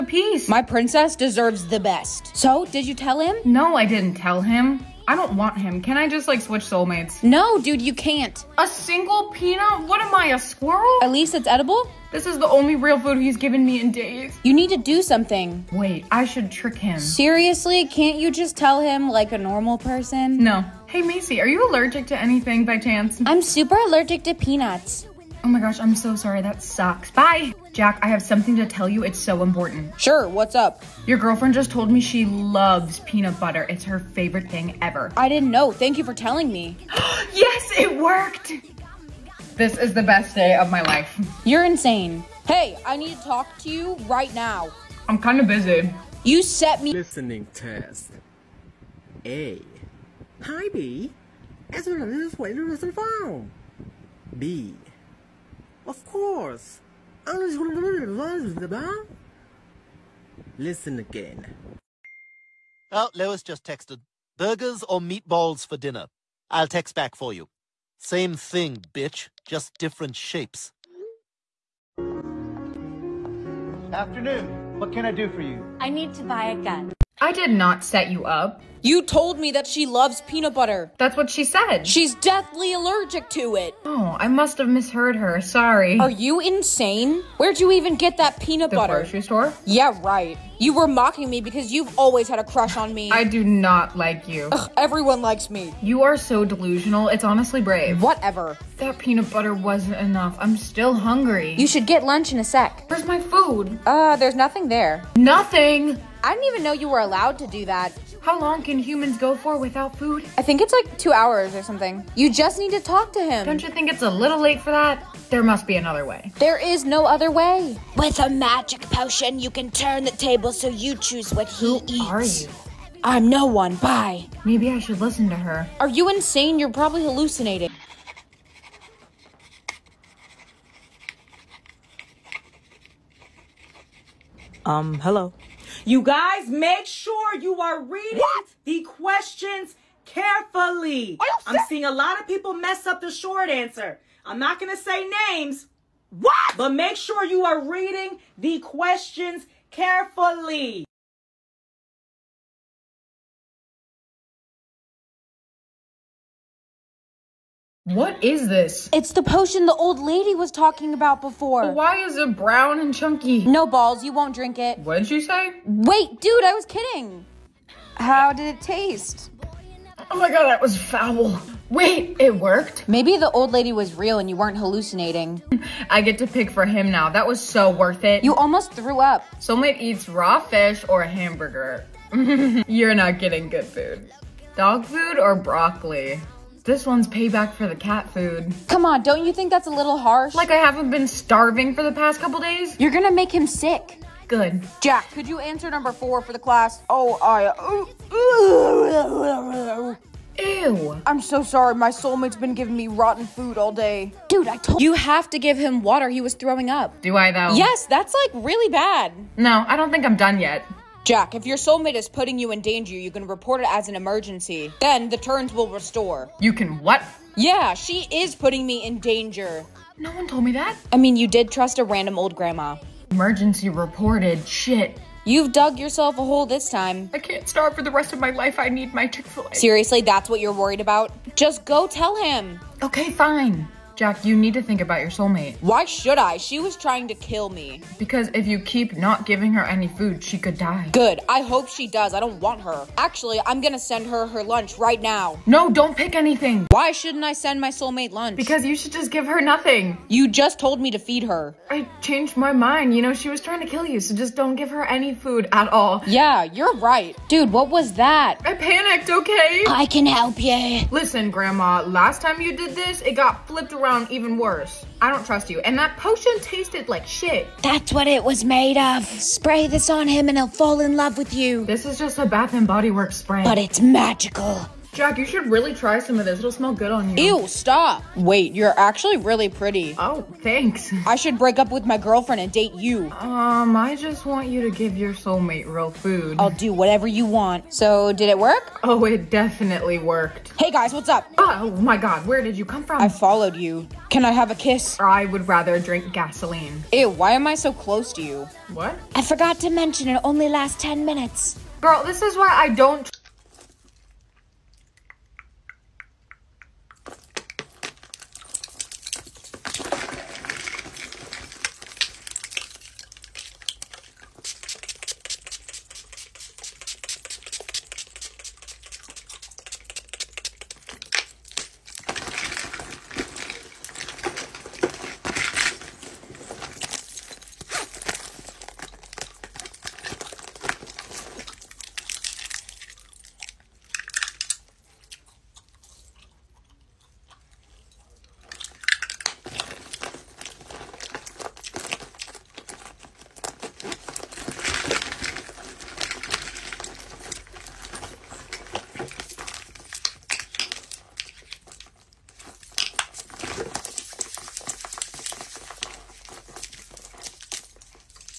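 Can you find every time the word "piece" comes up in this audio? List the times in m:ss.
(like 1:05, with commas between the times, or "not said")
0:00.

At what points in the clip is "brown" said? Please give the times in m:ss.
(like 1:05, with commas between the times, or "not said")
2:42.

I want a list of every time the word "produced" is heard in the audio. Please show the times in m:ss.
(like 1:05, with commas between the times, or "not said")
not said.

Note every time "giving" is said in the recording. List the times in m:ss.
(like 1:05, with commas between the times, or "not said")
3:22, 3:59.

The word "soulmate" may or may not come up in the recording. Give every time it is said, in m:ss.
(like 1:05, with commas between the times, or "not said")
0:06, 2:59, 3:21, 3:31, 3:55, 4:07, 4:45.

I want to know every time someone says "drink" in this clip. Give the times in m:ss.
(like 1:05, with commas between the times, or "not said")
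2:44, 4:55.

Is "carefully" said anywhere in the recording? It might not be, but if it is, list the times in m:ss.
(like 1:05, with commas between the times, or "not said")
2:20, 2:29.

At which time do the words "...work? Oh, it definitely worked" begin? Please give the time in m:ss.
4:48.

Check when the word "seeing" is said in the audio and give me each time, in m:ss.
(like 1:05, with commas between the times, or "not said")
2:21.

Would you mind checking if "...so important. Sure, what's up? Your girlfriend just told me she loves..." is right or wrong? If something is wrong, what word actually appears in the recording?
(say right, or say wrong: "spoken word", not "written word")
right.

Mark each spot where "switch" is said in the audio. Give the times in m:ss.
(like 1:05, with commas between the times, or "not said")
0:06.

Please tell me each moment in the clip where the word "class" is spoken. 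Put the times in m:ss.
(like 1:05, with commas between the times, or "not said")
3:16.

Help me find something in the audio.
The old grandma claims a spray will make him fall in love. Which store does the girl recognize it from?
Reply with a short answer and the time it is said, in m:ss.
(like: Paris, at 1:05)
Bath and Body Works, at 4:32.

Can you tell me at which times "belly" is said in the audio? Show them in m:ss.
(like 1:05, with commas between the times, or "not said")
not said.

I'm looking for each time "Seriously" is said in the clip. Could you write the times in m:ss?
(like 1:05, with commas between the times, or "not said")
0:16, 3:49.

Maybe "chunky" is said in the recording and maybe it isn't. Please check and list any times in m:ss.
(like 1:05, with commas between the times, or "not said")
2:42.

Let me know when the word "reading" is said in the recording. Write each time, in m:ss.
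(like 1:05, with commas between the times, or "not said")
2:17, 2:27.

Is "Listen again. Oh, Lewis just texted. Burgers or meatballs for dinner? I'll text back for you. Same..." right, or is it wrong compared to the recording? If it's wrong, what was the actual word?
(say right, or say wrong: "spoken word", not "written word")
right.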